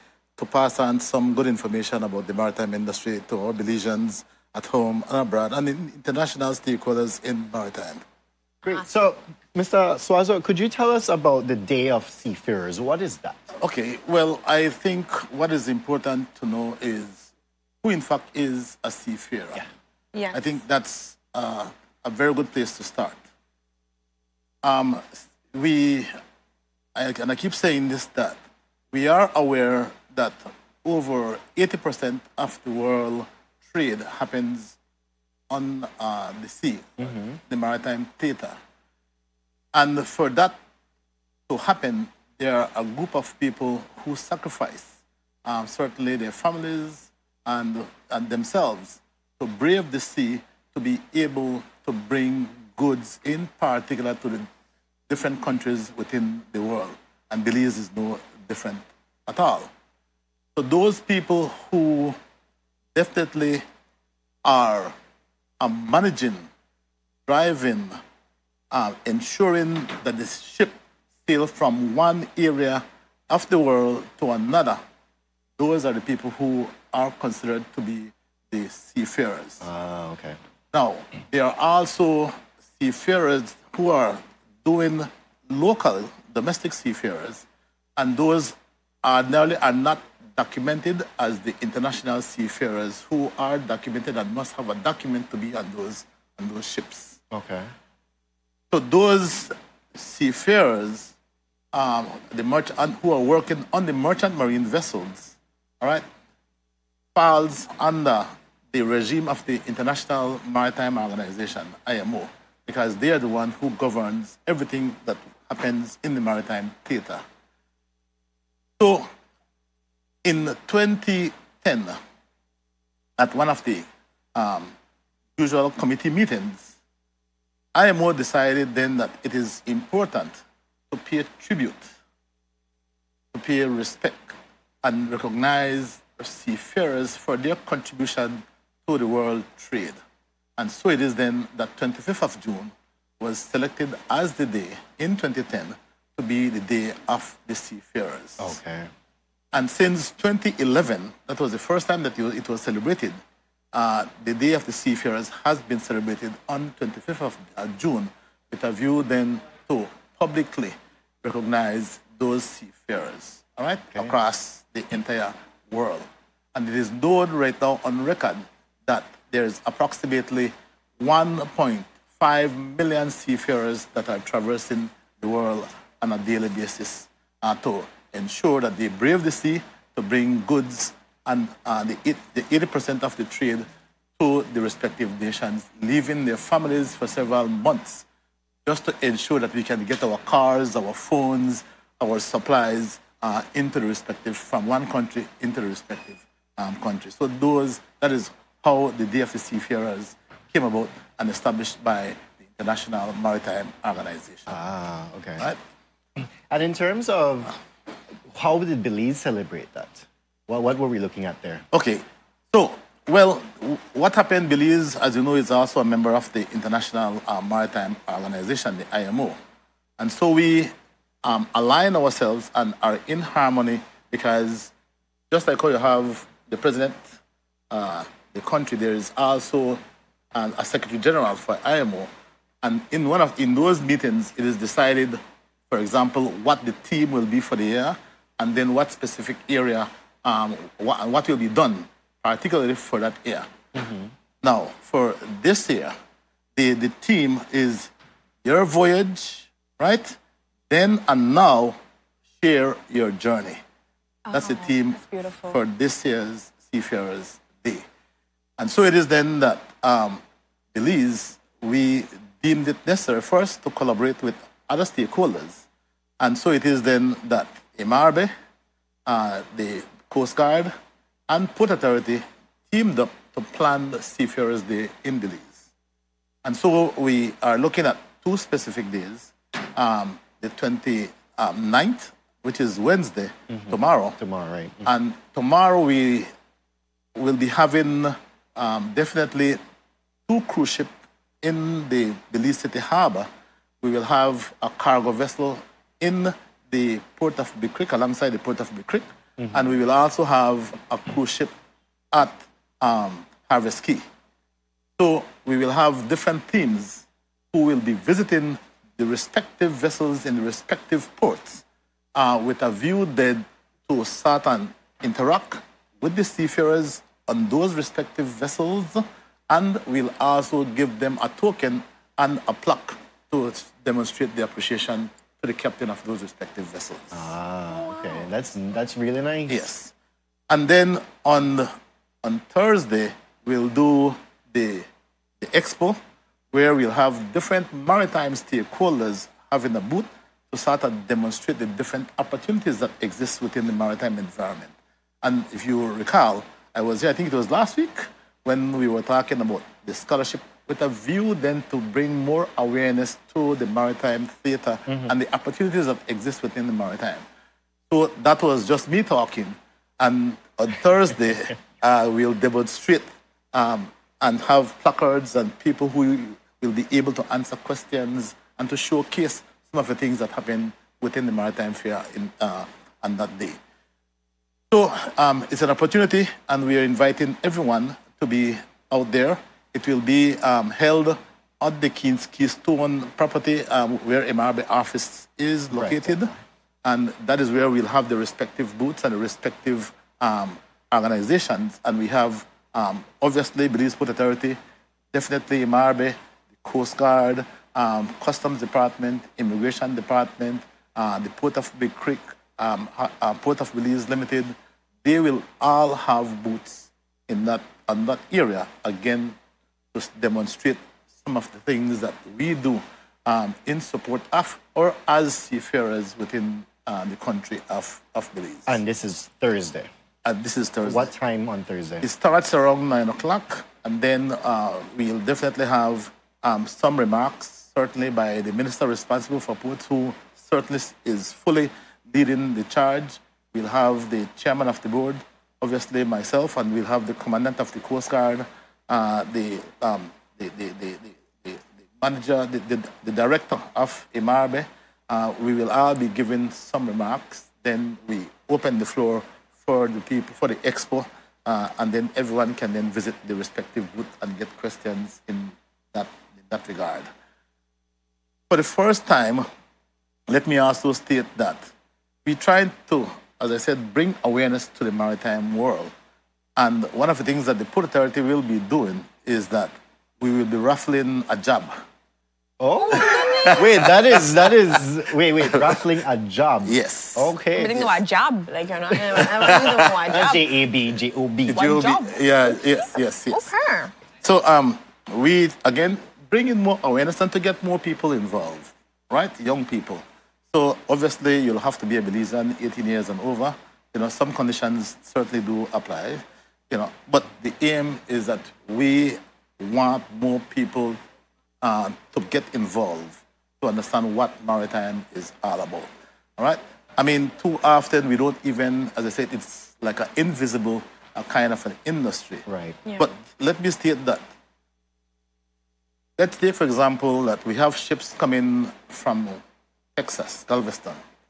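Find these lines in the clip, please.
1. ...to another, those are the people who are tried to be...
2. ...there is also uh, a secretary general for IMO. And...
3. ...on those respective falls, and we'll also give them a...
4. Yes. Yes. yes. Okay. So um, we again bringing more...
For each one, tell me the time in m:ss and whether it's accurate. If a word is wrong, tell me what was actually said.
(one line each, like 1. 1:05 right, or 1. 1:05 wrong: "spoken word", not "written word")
1. 1:14 wrong: "considered", not "tried"
2. 3:48 right
3. 5:17 wrong: "vessels", not "falls"
4. 8:02 right.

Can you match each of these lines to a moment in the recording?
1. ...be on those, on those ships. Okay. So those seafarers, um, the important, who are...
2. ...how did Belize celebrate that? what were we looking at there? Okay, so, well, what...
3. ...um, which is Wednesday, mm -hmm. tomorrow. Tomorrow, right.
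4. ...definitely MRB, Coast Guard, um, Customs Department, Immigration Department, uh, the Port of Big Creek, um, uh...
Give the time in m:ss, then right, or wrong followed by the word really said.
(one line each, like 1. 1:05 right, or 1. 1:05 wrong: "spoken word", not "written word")
1. 1:35 wrong: "merchant", not "important"
2. 3:28 right
3. 4:41 right
4. 6:35 right.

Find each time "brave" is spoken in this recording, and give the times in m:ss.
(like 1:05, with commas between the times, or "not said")
0:49, 2:58.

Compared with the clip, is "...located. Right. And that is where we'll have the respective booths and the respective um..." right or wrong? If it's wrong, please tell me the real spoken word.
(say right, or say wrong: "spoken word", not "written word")
right.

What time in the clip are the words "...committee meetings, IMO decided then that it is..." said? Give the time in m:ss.
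2:05.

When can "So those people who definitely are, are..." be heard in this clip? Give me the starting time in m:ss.
1:00.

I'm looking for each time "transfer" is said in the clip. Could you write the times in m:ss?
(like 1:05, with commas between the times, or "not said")
not said.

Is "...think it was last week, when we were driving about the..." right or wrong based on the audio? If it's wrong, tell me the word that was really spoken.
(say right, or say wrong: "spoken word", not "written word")
wrong: "talking", not "driving".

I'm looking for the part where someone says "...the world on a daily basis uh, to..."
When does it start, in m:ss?
2:55.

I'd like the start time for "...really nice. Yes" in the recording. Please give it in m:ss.
5:28.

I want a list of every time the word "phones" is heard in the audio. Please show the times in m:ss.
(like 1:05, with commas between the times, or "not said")
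3:10.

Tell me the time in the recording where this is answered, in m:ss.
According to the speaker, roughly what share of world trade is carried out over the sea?
0:30.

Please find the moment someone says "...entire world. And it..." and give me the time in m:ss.
2:44.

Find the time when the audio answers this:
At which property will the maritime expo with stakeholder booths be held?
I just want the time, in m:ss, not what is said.
6:21.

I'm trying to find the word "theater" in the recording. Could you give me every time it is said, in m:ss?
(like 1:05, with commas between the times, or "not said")
0:38, 1:56, 5:54.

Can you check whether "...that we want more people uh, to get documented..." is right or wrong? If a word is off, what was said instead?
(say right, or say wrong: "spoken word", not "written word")
wrong: "involved", not "documented".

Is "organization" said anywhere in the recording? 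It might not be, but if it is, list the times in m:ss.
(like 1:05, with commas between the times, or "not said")
1:51, 3:23, 3:38, 6:30.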